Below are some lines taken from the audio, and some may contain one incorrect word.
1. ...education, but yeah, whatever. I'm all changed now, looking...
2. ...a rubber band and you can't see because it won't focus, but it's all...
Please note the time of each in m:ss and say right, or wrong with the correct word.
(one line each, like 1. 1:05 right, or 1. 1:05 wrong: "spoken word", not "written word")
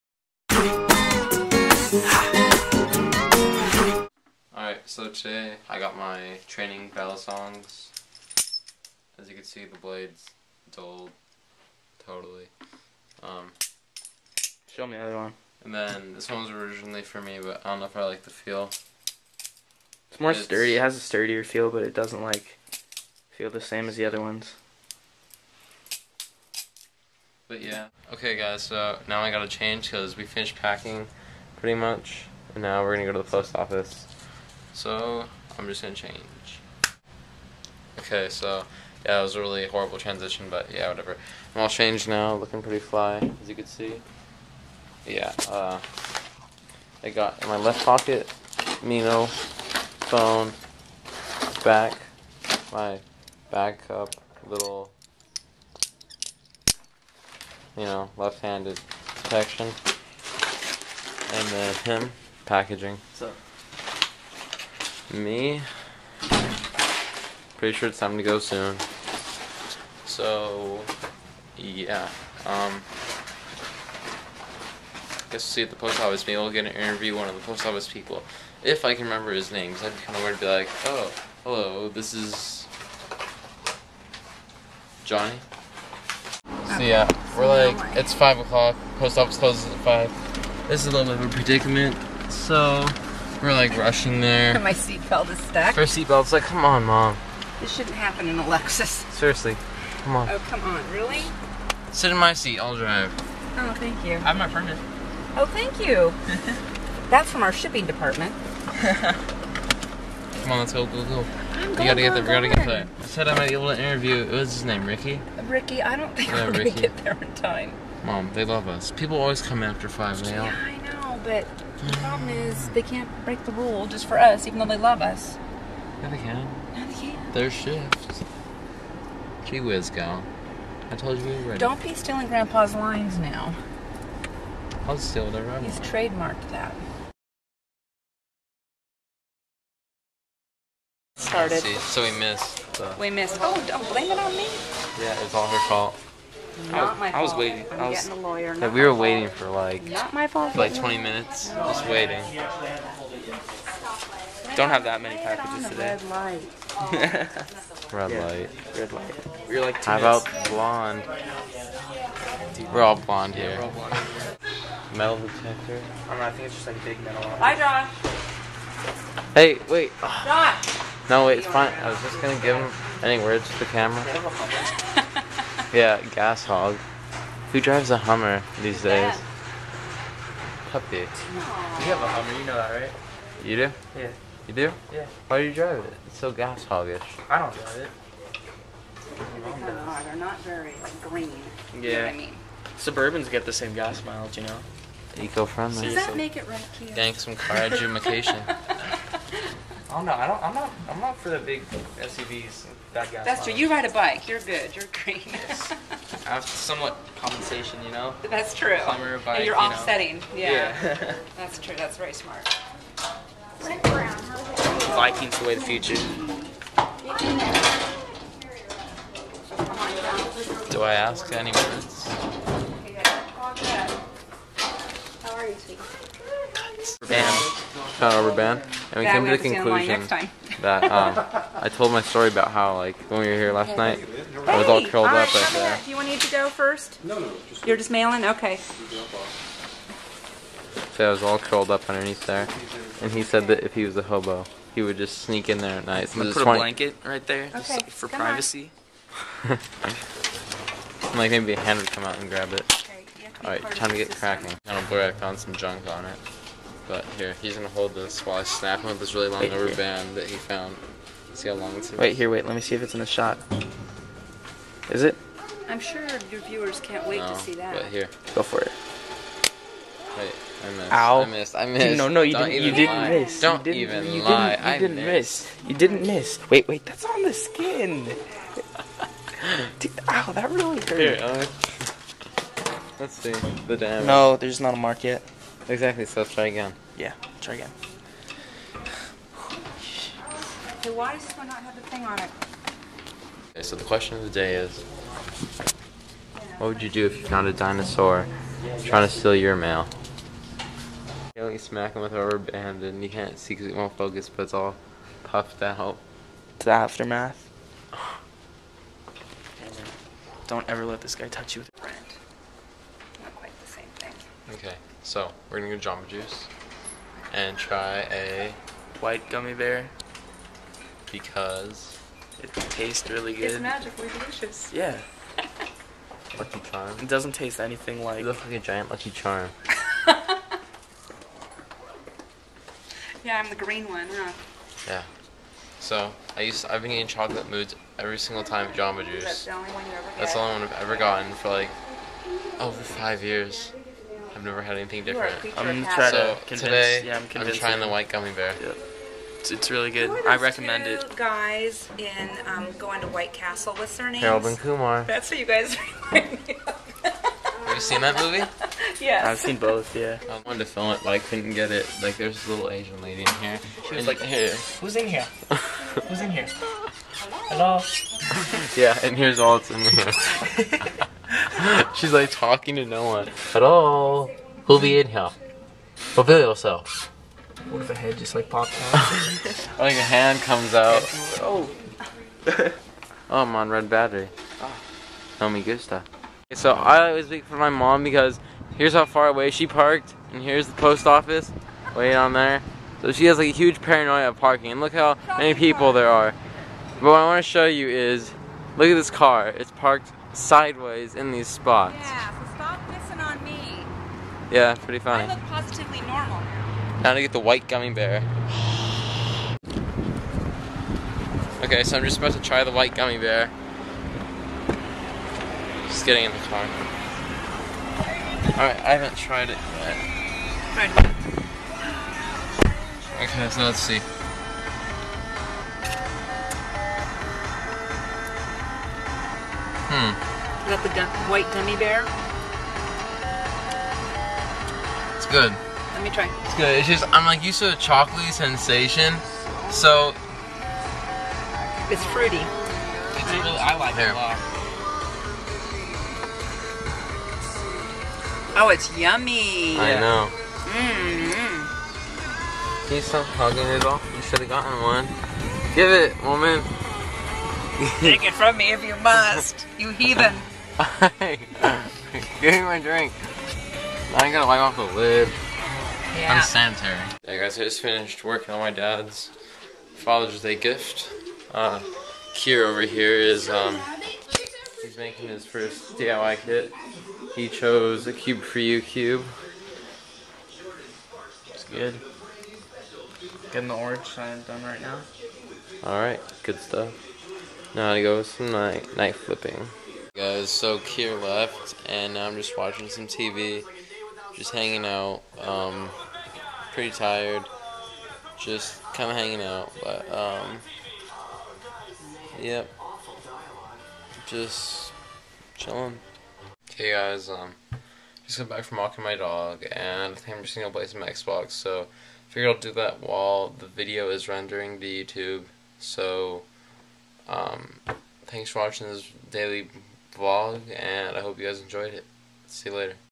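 1. 0:39 wrong: "transition", not "education"
2. 5:02 right.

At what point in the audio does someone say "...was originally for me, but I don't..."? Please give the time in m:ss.
0:16.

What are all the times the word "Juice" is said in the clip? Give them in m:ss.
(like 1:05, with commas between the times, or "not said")
5:16, 5:39.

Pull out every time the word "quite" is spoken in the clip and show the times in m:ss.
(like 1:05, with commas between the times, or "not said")
5:13.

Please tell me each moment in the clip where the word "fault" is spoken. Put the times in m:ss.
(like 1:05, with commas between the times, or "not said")
2:25, 2:30.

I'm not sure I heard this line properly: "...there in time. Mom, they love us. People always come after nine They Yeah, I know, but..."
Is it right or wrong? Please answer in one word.
wrong.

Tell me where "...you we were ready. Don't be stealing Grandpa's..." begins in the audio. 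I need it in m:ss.
2:11.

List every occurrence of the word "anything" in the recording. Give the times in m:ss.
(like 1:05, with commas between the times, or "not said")
5:27, 5:44.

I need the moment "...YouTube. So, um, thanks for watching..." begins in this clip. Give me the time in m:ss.
8:35.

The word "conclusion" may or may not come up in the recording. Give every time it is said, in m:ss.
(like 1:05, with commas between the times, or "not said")
3:49.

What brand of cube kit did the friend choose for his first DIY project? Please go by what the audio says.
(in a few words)
Cube4You.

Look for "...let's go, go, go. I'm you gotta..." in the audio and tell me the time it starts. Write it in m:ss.
1:50.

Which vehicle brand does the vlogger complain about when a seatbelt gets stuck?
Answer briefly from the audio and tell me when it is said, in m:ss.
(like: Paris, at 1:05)
Lexus, at 1:38.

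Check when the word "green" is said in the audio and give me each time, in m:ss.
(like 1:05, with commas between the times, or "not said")
3:11, 3:25, 5:33.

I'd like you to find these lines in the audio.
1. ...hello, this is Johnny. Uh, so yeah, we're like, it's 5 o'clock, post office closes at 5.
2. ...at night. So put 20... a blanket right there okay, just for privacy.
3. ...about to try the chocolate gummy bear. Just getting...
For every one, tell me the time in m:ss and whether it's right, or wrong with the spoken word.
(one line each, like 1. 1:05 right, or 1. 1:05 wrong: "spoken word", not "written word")
1. 1:21 right
2. 4:05 right
3. 6:52 wrong: "white", not "chocolate".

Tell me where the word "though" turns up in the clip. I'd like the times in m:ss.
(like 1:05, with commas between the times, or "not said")
2:04.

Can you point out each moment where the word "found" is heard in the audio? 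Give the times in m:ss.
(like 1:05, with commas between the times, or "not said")
4:20, 4:57.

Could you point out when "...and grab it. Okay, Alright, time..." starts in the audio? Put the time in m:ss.
4:12.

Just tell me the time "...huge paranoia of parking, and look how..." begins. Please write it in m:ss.
6:33.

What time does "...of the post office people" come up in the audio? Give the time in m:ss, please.
1:17.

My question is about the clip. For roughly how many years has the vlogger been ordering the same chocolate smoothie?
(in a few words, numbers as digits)
5 years.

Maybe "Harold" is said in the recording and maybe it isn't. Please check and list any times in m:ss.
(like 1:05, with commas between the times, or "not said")
5:54.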